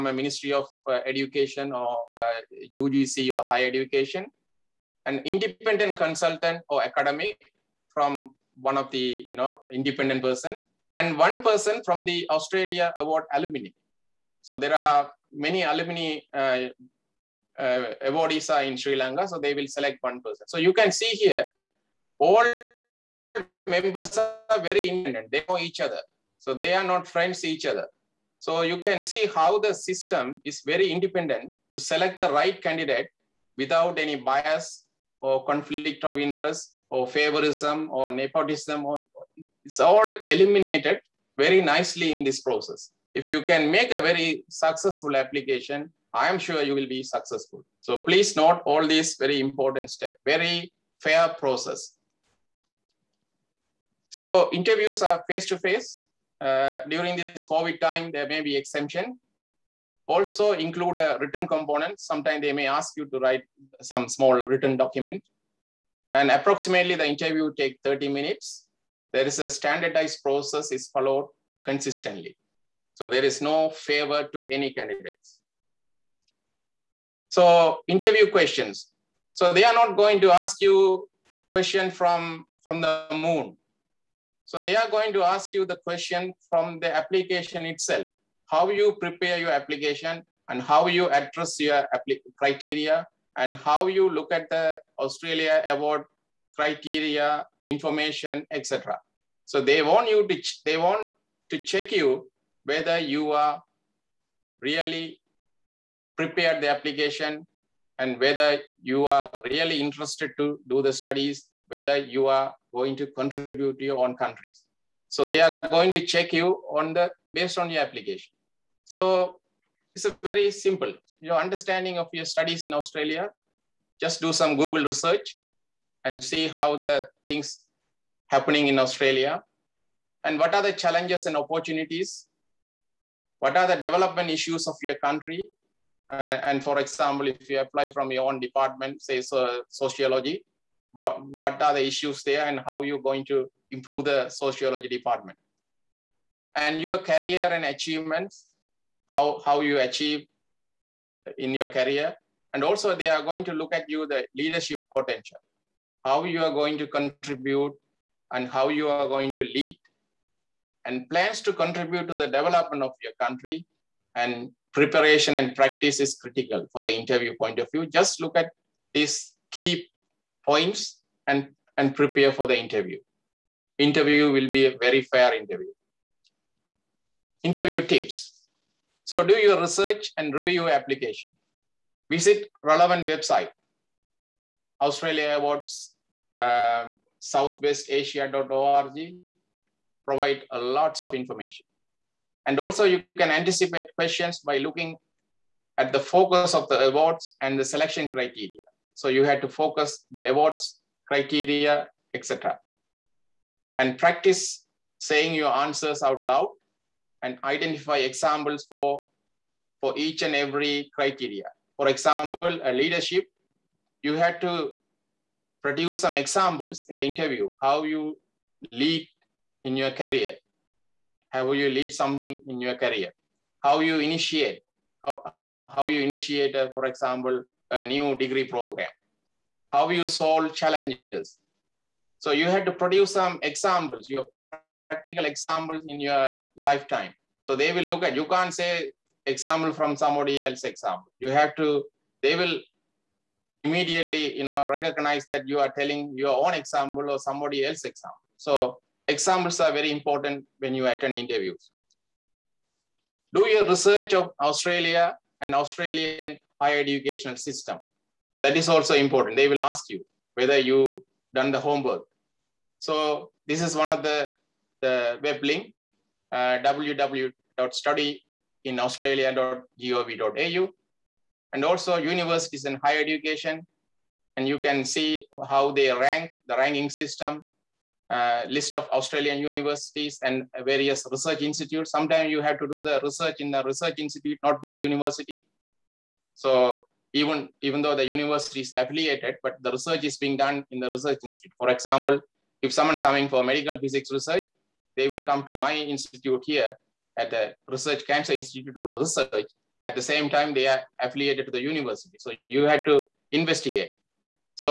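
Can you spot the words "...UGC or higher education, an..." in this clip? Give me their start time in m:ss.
0:02.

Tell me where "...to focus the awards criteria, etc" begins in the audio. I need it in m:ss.
3:19.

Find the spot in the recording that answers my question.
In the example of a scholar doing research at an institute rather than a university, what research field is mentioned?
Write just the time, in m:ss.
4:53.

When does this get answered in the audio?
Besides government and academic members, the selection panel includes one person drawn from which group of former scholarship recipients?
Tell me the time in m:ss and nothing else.
0:12.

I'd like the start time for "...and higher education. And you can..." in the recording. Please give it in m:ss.
4:32.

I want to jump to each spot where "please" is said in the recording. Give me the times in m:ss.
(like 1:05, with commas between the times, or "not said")
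0:47.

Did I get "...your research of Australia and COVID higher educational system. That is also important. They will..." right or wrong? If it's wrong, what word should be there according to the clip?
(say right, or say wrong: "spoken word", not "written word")
wrong: "Australian", not "COVID".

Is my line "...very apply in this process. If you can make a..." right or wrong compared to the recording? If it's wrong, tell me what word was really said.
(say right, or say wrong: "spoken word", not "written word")
wrong: "nicely", not "apply".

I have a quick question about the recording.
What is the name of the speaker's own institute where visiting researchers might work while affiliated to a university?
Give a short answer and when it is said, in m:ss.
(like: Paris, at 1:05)
Research Cancer Institute, at 4:57.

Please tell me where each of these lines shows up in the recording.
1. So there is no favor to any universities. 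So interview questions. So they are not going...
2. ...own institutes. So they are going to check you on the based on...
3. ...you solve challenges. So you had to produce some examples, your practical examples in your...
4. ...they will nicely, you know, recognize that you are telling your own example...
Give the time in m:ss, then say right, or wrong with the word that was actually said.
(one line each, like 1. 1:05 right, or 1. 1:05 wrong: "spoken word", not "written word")
1. 1:12 wrong: "candidates", not "universities"
2. 1:53 wrong: "countries", not "institutes"
3. 3:49 right
4. 4:02 wrong: "immediately", not "nicely".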